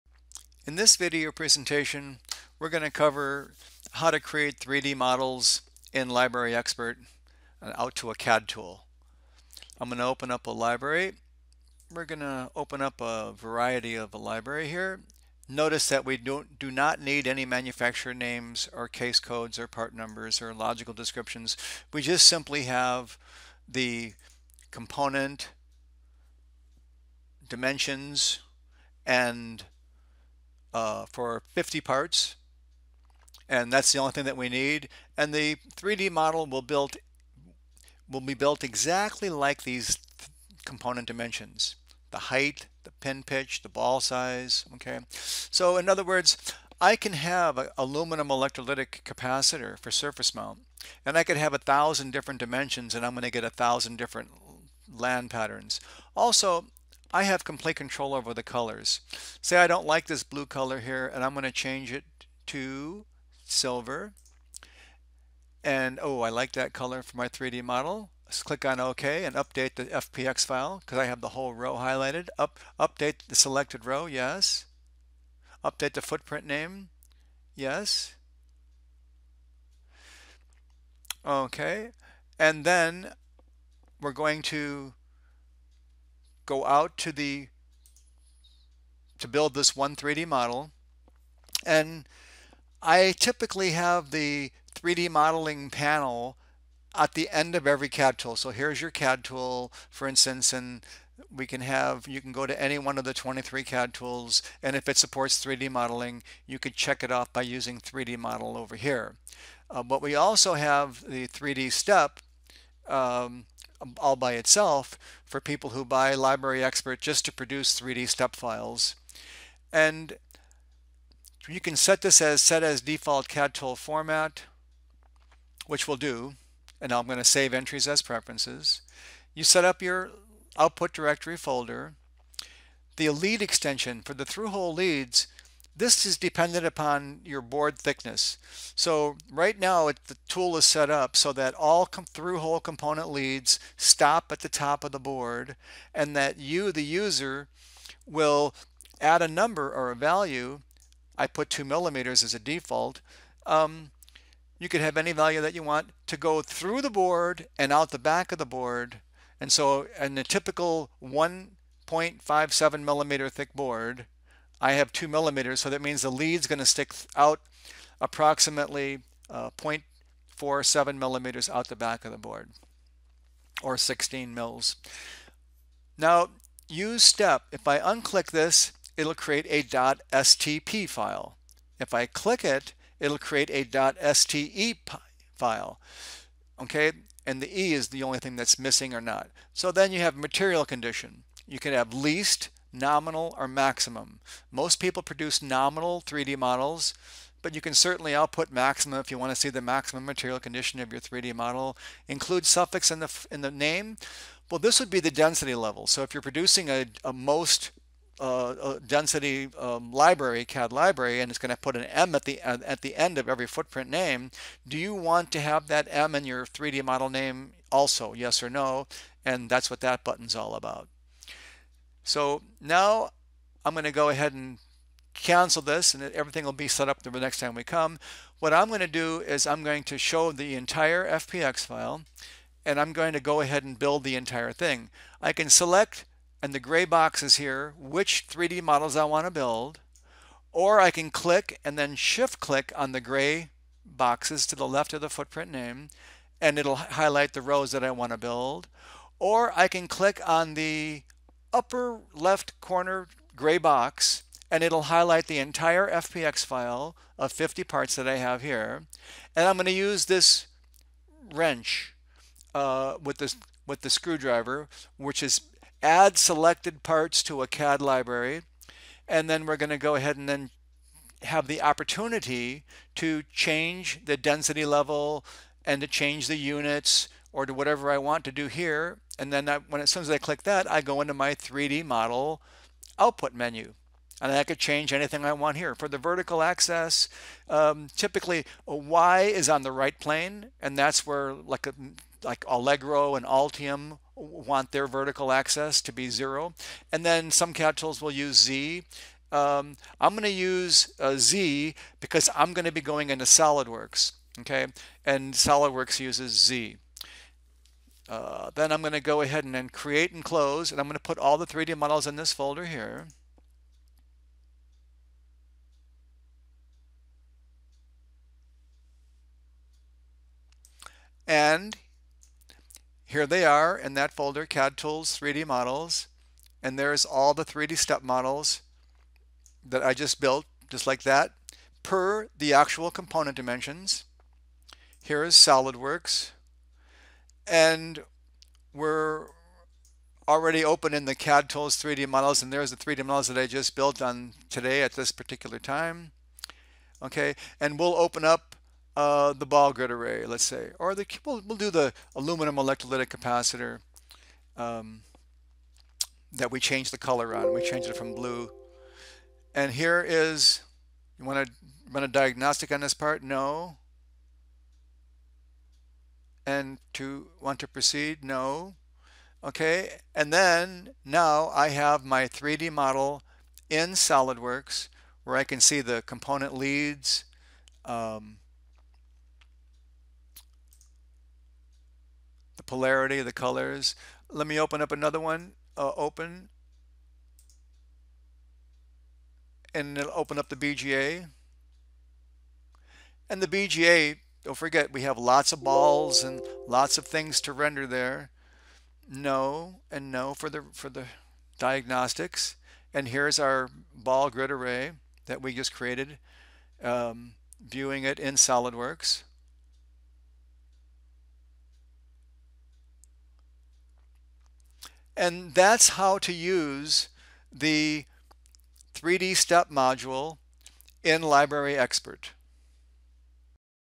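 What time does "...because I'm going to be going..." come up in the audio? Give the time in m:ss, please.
5:01.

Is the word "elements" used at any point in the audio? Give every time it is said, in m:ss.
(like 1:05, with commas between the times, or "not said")
not said.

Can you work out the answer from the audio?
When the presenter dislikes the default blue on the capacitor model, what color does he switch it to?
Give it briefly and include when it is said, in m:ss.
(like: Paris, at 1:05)
Silver, at 1:03.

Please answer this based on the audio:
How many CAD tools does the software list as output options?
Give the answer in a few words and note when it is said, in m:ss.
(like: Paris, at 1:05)
23, at 1:43.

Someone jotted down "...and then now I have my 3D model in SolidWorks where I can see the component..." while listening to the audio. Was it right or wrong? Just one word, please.
right.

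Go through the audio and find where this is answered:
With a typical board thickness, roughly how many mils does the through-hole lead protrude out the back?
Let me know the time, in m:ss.
2:53.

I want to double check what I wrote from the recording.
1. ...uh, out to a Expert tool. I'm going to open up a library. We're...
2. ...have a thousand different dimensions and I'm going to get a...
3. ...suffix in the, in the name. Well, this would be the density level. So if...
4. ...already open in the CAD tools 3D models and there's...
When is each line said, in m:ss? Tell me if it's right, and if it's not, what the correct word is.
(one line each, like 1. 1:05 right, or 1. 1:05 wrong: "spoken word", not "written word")
1. 0:07 wrong: "CAD", not "Expert"
2. 0:51 right
3. 3:22 right
4. 5:40 right.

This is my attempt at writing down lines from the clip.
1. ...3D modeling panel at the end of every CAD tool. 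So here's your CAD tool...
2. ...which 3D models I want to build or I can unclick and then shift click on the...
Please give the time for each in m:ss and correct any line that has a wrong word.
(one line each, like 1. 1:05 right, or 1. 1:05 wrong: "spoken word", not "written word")
1. 1:34 right
2. 3:57 wrong: "click", not "unclick".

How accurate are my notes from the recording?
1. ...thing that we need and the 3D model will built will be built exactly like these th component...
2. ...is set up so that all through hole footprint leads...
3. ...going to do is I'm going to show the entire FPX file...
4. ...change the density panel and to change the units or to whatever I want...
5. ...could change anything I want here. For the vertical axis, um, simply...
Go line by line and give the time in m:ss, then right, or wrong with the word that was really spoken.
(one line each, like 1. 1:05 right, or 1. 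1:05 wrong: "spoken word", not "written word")
1. 0:34 right
2. 2:20 wrong: "component", not "footprint"
3. 3:48 right
4. 4:33 wrong: "level", not "panel"
5. 4:44 wrong: "typically", not "simply".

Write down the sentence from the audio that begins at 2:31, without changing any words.
I put two millimeters as a default.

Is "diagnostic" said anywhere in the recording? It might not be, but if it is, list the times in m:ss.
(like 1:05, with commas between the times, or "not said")
6:02, 6:41.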